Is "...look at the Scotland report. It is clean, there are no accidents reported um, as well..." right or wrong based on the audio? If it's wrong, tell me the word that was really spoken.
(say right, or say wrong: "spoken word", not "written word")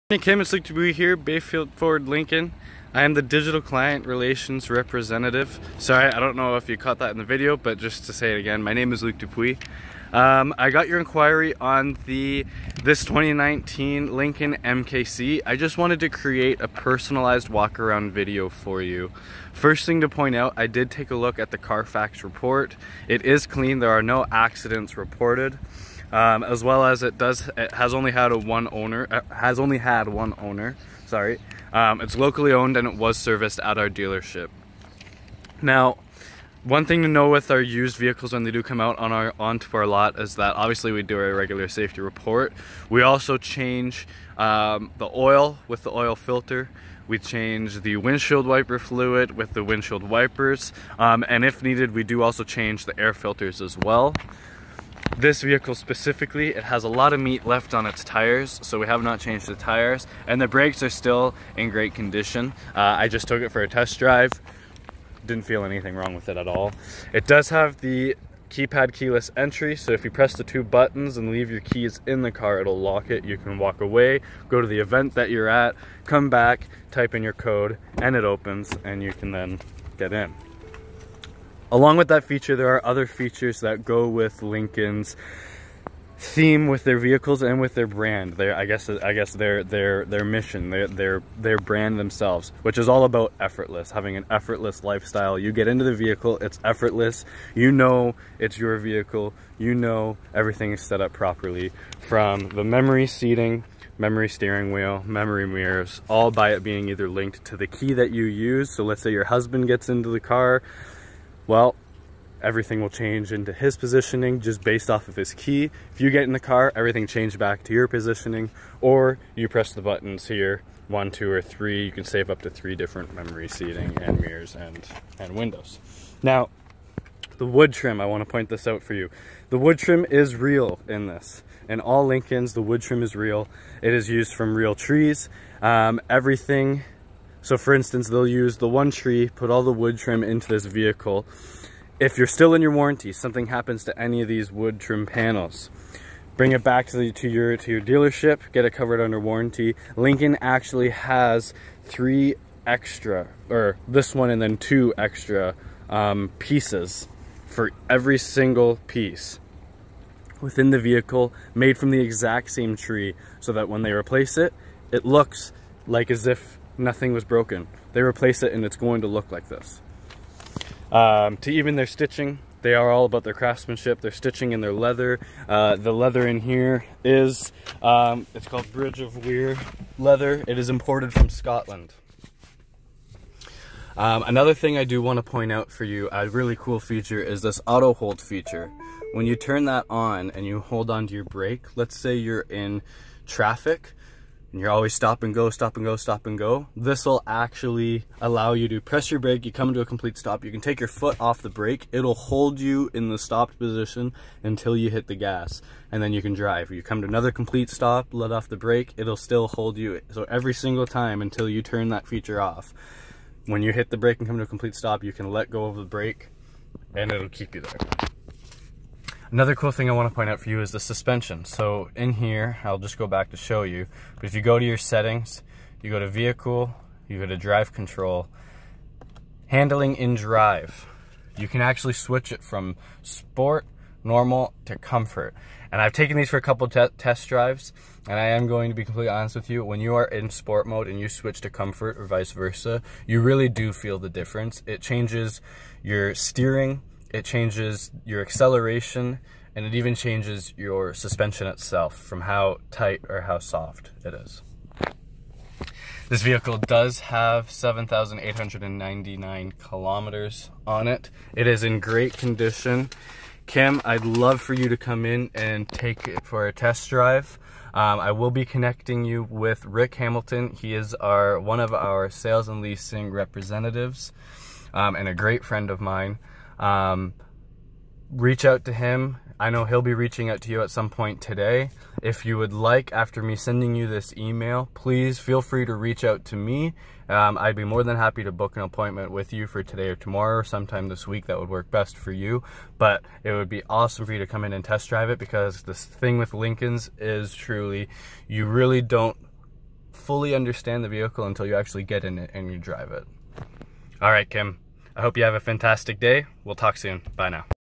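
wrong: "Carfax", not "Scotland".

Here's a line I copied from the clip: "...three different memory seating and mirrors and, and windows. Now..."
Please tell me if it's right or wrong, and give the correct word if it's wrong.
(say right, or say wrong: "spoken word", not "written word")
right.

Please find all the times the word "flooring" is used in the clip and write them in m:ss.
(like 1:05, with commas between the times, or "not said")
not said.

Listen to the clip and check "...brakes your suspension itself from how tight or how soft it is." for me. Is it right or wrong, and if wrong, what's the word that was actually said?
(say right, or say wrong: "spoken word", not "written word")
wrong: "changes", not "brakes".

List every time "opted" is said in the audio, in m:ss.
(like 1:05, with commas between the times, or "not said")
not said.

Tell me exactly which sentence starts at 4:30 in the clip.
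He is our one of our sales and leasing representatives um, and a great friend of mine.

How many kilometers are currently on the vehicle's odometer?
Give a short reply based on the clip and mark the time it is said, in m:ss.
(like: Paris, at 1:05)
7,899, at 4:17.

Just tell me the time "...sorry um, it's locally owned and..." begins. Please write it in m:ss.
0:31.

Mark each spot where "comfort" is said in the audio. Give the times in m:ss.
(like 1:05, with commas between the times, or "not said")
3:54, 4:01.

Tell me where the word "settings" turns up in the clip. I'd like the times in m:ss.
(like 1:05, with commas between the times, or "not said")
3:44.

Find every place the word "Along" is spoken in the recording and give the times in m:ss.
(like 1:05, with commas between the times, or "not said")
1:21.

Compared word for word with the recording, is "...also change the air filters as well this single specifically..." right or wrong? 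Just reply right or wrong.
wrong.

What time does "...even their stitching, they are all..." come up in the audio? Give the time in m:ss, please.
2:51.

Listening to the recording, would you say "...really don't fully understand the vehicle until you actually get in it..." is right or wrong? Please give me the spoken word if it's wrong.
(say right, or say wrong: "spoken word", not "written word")
right.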